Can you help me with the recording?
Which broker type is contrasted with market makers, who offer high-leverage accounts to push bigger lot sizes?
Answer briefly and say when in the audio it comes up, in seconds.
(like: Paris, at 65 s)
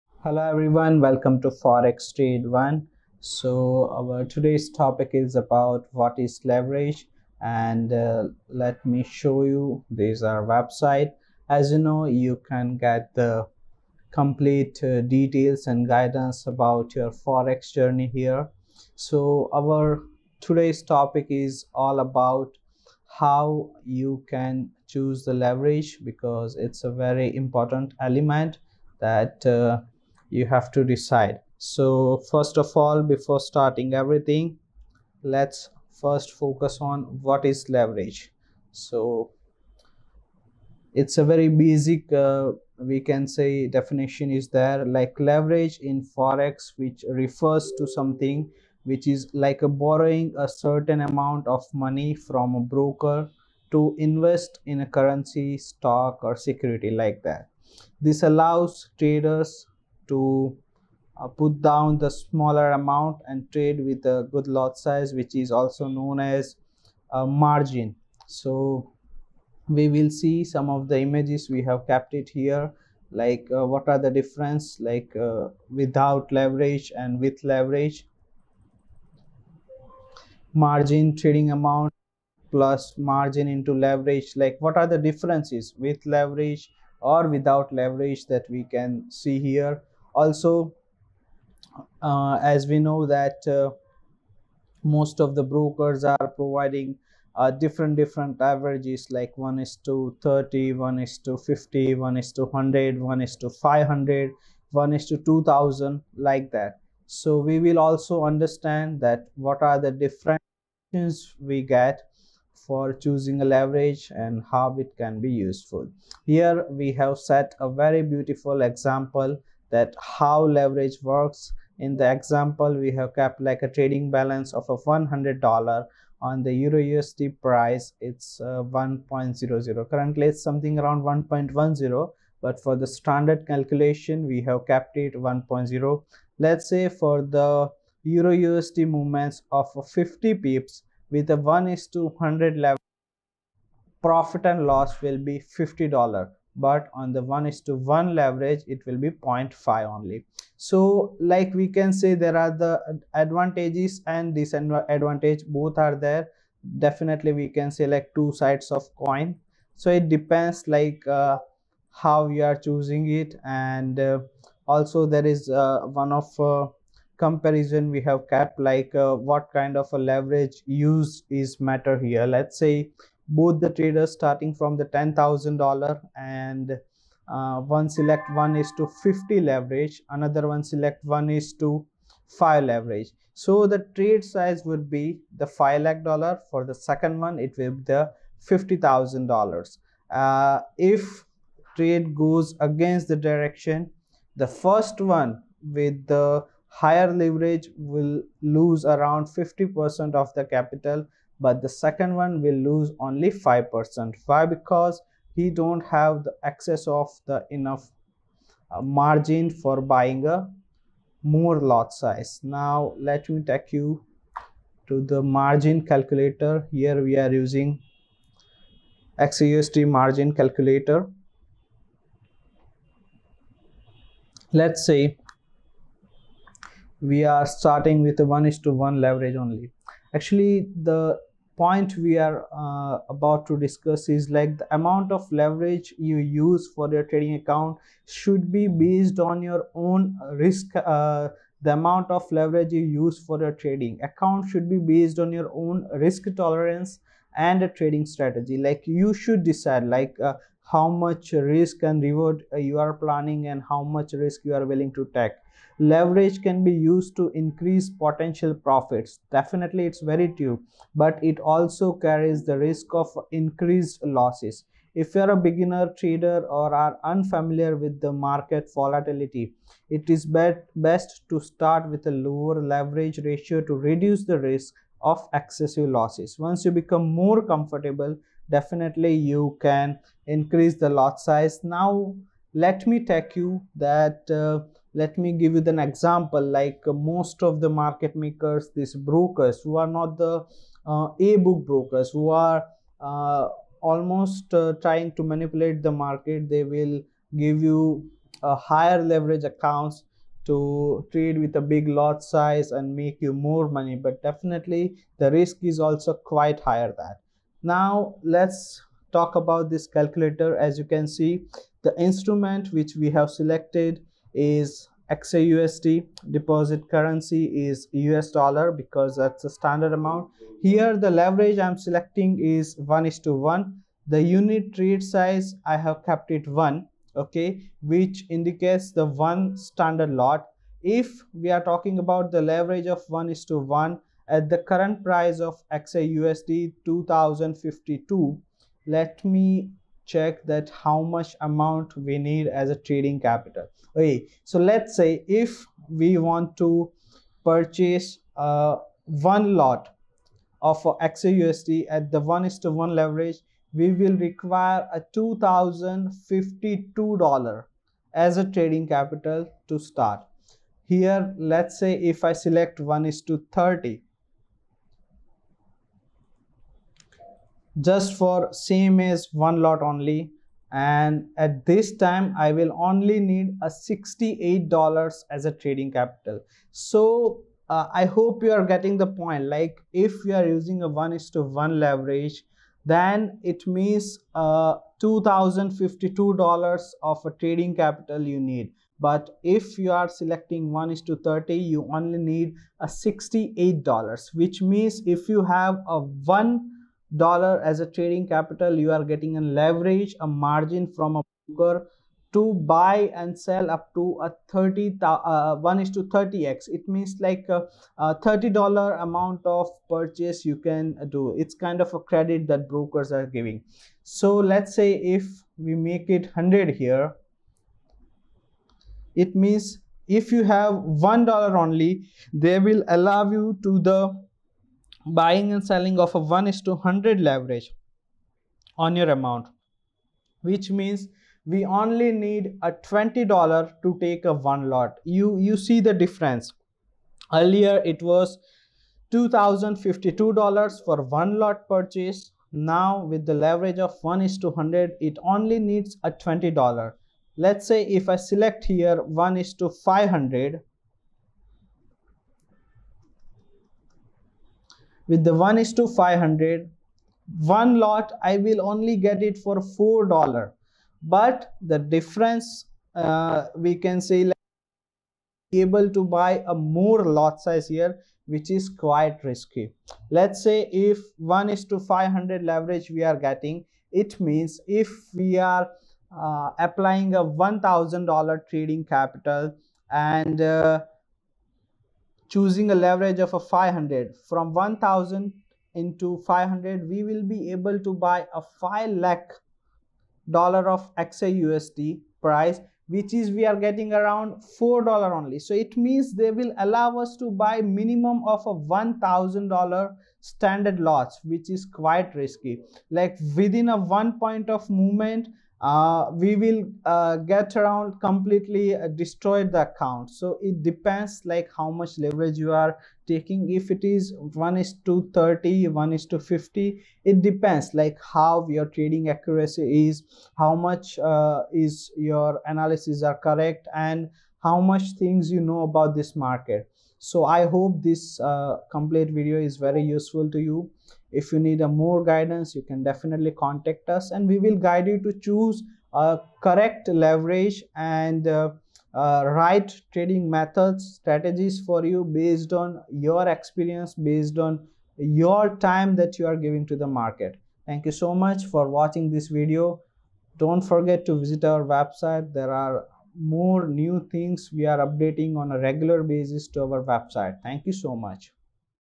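A book brokers, at 291 s.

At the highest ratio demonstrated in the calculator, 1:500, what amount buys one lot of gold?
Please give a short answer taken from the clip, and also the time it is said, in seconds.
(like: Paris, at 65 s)
$4, at 459 s.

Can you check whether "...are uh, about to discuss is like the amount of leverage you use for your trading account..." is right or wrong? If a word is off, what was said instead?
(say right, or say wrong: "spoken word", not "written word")
right.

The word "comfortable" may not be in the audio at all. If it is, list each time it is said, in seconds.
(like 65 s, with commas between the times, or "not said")
277 s.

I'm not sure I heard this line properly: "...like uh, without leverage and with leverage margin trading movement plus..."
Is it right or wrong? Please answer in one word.
wrong.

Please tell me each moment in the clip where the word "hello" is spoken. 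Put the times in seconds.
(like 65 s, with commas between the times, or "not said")
0 s.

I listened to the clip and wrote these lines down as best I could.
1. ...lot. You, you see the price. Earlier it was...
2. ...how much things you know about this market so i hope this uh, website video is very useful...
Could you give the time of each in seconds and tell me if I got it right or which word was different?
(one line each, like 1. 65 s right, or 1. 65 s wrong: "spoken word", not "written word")
1. 434 s wrong: "difference", not "price"
2. 524 s wrong: "complete", not "website".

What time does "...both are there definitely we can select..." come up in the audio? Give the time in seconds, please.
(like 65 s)
155 s.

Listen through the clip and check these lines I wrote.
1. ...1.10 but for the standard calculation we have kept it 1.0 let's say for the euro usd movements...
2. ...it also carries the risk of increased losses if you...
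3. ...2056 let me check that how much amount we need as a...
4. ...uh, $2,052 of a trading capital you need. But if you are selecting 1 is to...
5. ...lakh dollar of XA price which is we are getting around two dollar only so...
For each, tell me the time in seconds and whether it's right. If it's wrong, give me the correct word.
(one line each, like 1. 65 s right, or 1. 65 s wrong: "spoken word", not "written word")
1. 131 s right
2. 261 s right
3. 336 s wrong: "2052", not "2056"
4. 384 s right
5. 488 s wrong: "four", not "two".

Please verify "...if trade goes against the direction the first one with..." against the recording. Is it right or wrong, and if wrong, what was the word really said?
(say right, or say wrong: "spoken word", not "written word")
right.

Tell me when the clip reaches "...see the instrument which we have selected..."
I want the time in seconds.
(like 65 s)
311 s.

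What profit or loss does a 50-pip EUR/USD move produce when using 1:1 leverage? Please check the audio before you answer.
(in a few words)
0.5.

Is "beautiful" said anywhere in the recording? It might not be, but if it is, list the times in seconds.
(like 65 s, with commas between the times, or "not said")
118 s.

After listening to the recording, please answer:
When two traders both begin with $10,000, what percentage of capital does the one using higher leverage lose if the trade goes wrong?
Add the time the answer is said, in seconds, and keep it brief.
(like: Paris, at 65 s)
50%, at 199 s.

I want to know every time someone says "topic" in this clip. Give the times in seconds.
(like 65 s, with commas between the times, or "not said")
4 s, 20 s.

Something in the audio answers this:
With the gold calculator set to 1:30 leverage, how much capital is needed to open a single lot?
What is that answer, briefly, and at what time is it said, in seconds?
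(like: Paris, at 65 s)
$68, at 373 s.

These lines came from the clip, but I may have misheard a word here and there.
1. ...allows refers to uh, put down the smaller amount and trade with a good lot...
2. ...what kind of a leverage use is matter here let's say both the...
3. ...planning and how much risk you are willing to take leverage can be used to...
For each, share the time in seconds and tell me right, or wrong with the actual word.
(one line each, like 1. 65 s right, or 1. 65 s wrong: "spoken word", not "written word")
1. 58 s wrong: "traders", not "refers"
2. 169 s right
3. 252 s right.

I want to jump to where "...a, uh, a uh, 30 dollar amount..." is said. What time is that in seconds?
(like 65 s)
407 s.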